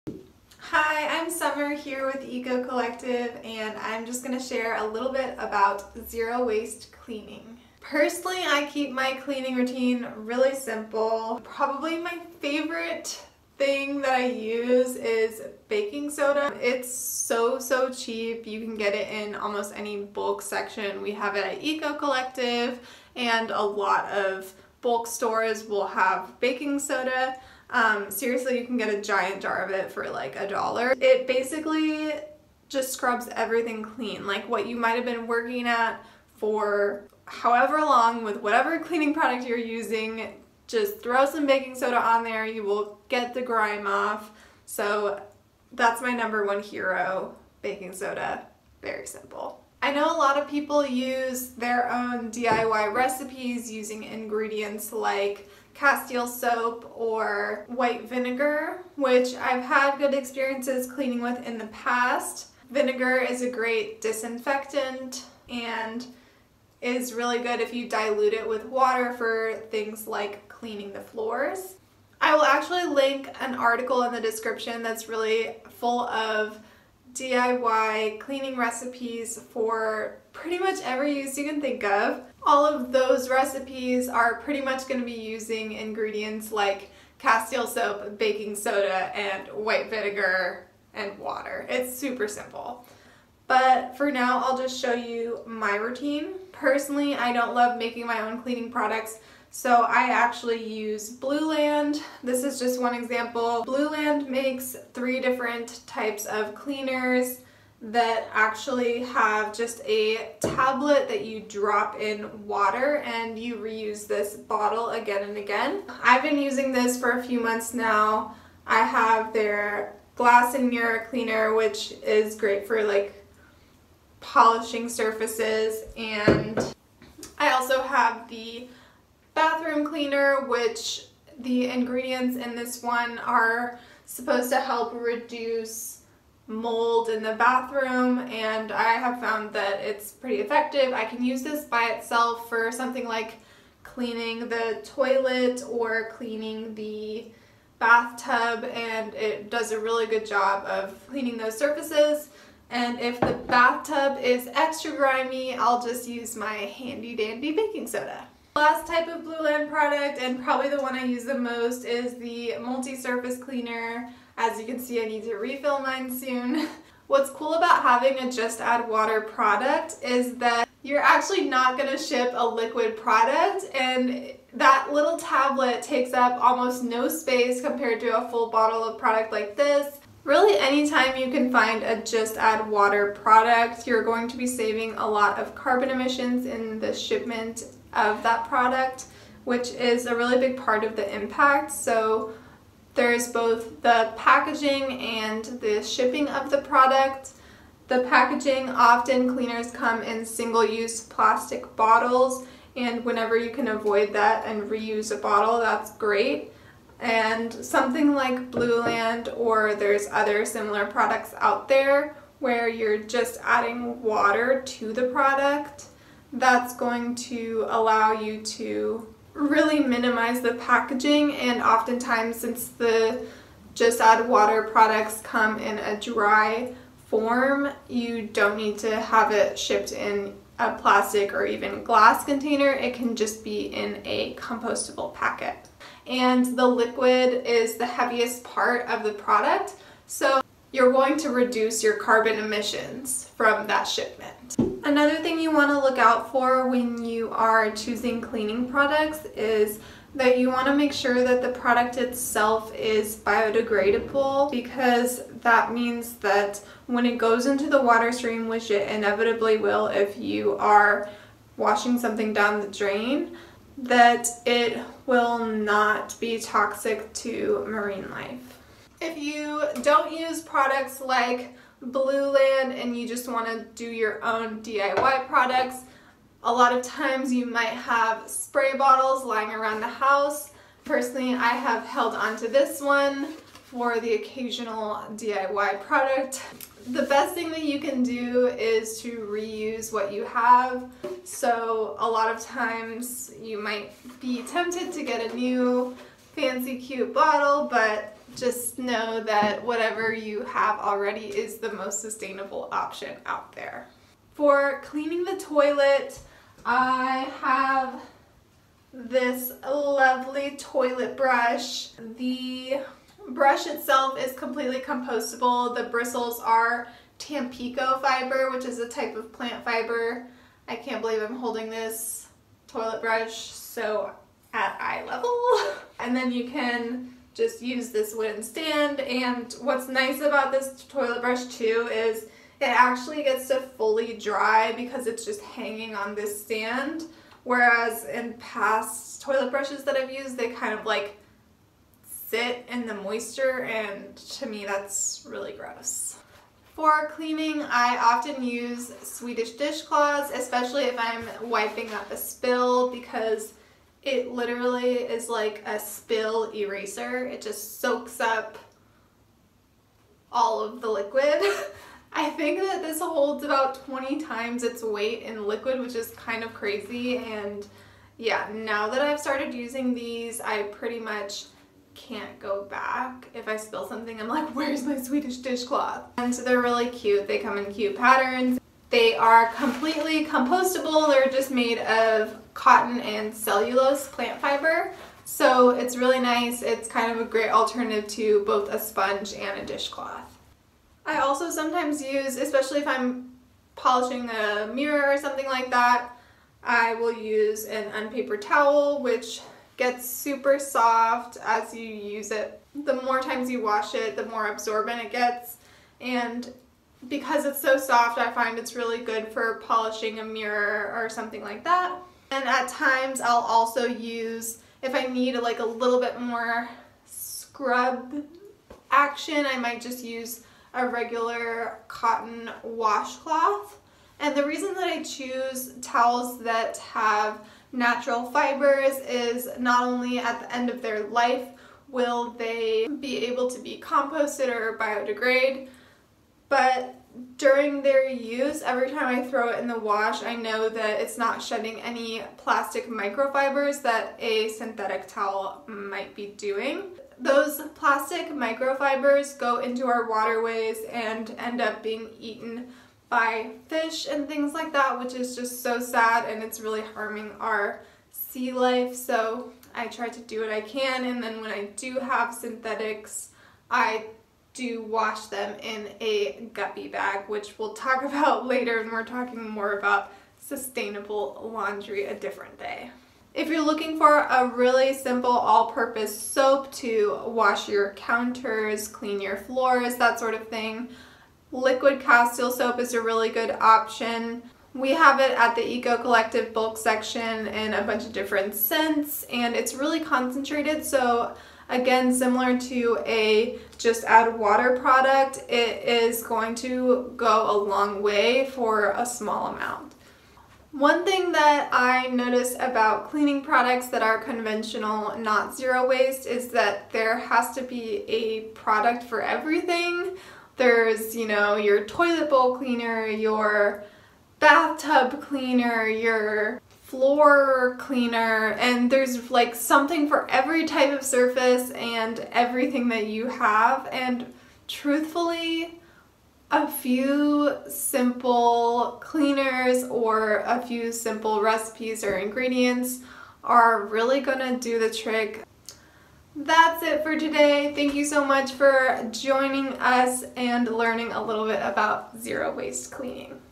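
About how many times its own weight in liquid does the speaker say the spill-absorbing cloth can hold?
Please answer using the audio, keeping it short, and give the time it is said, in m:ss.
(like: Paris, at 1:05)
20, at 6:03.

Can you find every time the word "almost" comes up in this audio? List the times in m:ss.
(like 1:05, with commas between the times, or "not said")
0:19, 2:56.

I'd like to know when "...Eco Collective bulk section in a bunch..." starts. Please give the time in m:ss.
8:05.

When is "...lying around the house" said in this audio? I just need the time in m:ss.
4:39.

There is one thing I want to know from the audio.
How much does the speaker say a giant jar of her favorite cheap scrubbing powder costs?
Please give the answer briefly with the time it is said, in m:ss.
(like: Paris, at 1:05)
$1, at 0:30.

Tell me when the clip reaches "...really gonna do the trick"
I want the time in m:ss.
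8:53.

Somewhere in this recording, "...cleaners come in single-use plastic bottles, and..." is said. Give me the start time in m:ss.
3:19.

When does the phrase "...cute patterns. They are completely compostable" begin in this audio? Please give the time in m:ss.
6:17.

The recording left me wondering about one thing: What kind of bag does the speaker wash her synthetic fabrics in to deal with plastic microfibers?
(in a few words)
Guppy bag.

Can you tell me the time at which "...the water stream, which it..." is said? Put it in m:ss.
4:17.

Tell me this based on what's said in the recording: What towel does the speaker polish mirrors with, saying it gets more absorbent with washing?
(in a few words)
Unpapered towel.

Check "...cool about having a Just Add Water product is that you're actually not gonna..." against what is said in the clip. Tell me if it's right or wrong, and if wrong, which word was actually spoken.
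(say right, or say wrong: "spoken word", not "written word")
right.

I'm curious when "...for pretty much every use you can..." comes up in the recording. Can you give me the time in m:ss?
1:19.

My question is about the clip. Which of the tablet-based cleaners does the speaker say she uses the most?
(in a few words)
Multi-surface cleaner.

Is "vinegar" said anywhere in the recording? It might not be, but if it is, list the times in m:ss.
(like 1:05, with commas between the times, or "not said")
0:58, 1:02, 1:29.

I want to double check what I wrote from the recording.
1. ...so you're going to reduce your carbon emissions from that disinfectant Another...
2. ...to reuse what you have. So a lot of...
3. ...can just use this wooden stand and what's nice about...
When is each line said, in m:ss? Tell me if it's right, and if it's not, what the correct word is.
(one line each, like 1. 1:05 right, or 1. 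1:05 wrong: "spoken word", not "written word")
1. 4:00 wrong: "shipment", not "disinfectant"
2. 4:49 right
3. 5:26 right.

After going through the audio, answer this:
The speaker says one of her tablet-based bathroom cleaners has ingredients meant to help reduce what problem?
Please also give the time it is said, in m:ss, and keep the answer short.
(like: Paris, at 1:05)
Mold, at 2:16.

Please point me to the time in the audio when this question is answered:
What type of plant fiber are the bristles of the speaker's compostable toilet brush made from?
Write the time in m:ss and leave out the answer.
5:17.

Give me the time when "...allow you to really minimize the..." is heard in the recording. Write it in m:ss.
3:37.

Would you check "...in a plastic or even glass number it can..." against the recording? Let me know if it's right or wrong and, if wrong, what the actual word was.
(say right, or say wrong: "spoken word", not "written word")
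wrong: "container", not "number".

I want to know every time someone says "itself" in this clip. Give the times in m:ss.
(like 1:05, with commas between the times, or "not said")
2:21, 4:11, 5:13.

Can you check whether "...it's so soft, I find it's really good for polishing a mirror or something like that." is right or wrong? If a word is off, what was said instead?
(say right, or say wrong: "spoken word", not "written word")
right.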